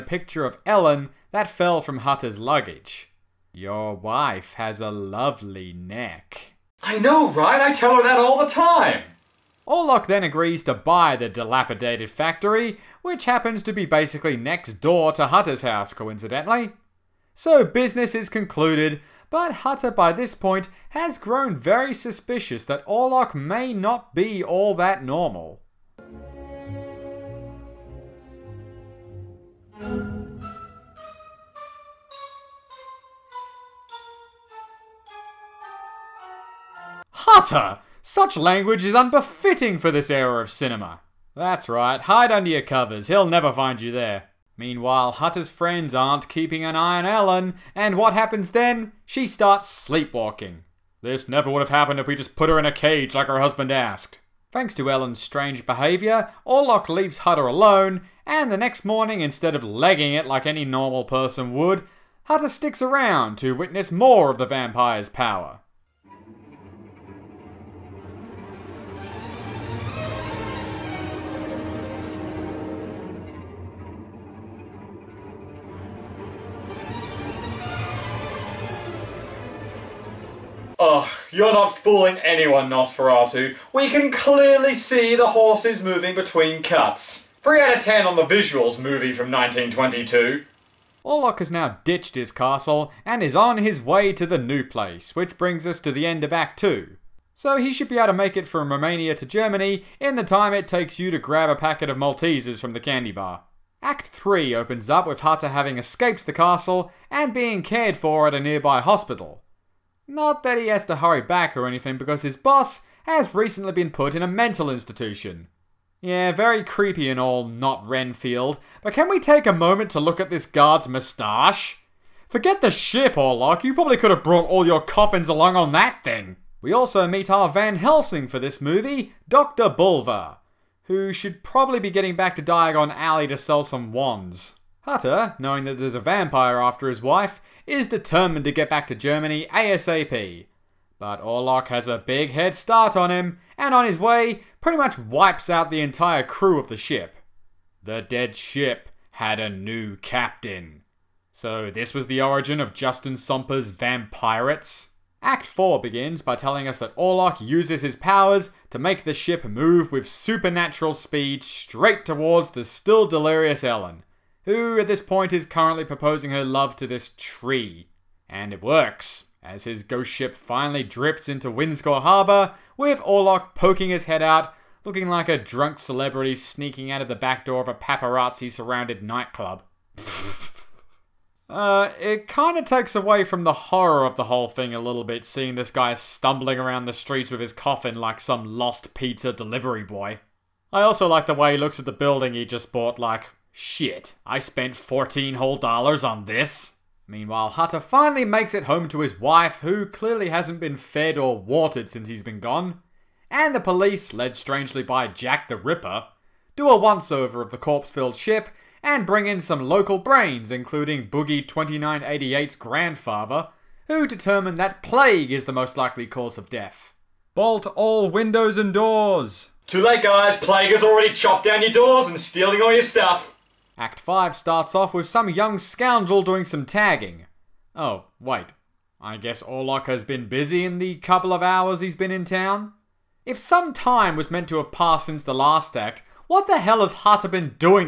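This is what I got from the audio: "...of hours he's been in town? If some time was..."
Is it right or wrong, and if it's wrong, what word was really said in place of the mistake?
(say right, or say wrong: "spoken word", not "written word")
right.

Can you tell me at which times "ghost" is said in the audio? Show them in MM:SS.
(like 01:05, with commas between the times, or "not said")
02:49.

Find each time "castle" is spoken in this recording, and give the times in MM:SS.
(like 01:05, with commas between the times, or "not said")
01:32, 01:46.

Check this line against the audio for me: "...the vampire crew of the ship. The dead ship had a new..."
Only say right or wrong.
wrong.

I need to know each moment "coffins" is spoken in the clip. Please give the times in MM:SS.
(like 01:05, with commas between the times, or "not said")
02:04, 03:07.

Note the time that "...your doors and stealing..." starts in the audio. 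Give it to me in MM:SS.
03:41.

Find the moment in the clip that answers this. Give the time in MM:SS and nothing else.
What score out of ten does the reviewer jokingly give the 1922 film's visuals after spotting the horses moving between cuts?
01:27.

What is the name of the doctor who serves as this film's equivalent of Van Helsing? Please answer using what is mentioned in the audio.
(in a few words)
Dr. Bulwer.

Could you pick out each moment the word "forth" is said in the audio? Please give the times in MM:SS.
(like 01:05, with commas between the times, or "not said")
not said.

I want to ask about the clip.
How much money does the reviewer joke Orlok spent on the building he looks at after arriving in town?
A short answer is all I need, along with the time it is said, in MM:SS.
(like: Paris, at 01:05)
$14, at 03:14.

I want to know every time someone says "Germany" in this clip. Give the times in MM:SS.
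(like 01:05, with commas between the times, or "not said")
01:39, 02:18.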